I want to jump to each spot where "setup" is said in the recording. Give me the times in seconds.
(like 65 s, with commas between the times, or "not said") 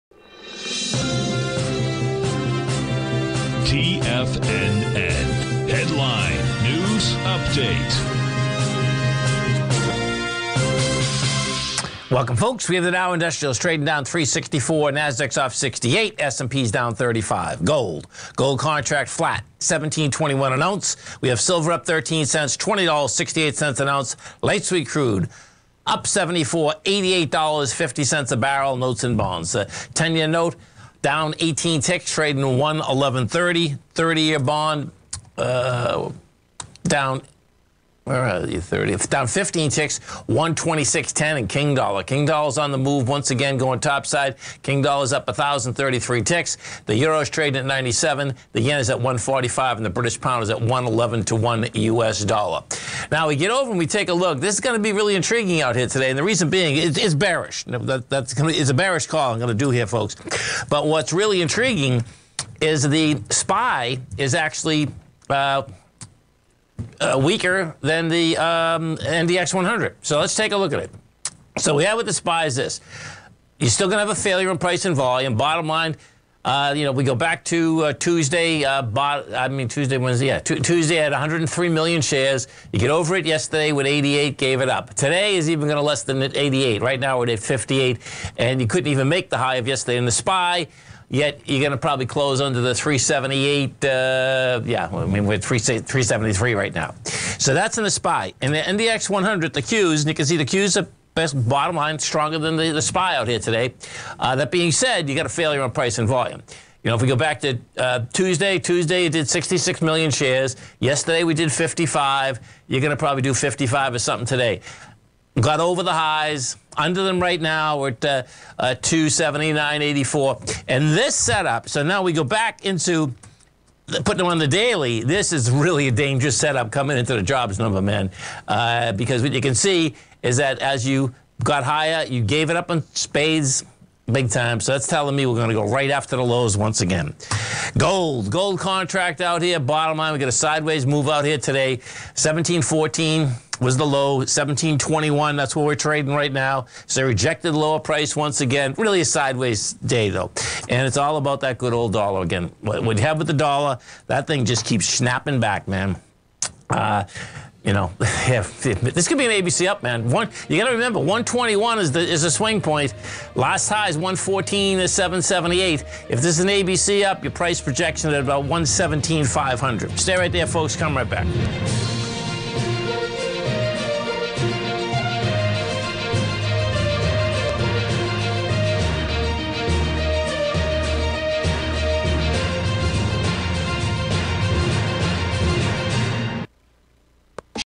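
121 s, 126 s.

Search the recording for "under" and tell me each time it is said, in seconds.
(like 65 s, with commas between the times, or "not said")
92 s, 116 s.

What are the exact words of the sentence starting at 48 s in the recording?
The Yen is at 145 and the British Pound is at 111 to 1 U.S.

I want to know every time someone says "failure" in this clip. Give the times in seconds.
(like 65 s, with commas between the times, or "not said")
74 s, 105 s.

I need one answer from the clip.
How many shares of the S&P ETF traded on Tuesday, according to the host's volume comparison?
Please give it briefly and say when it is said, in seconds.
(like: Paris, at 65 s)
103 million, at 81 s.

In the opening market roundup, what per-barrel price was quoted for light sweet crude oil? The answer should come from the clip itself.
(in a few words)
$88.50.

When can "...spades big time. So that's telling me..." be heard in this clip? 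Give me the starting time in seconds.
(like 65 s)
132 s.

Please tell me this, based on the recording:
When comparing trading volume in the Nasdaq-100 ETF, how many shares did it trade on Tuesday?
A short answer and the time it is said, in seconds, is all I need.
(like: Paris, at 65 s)
66 million, at 109 s.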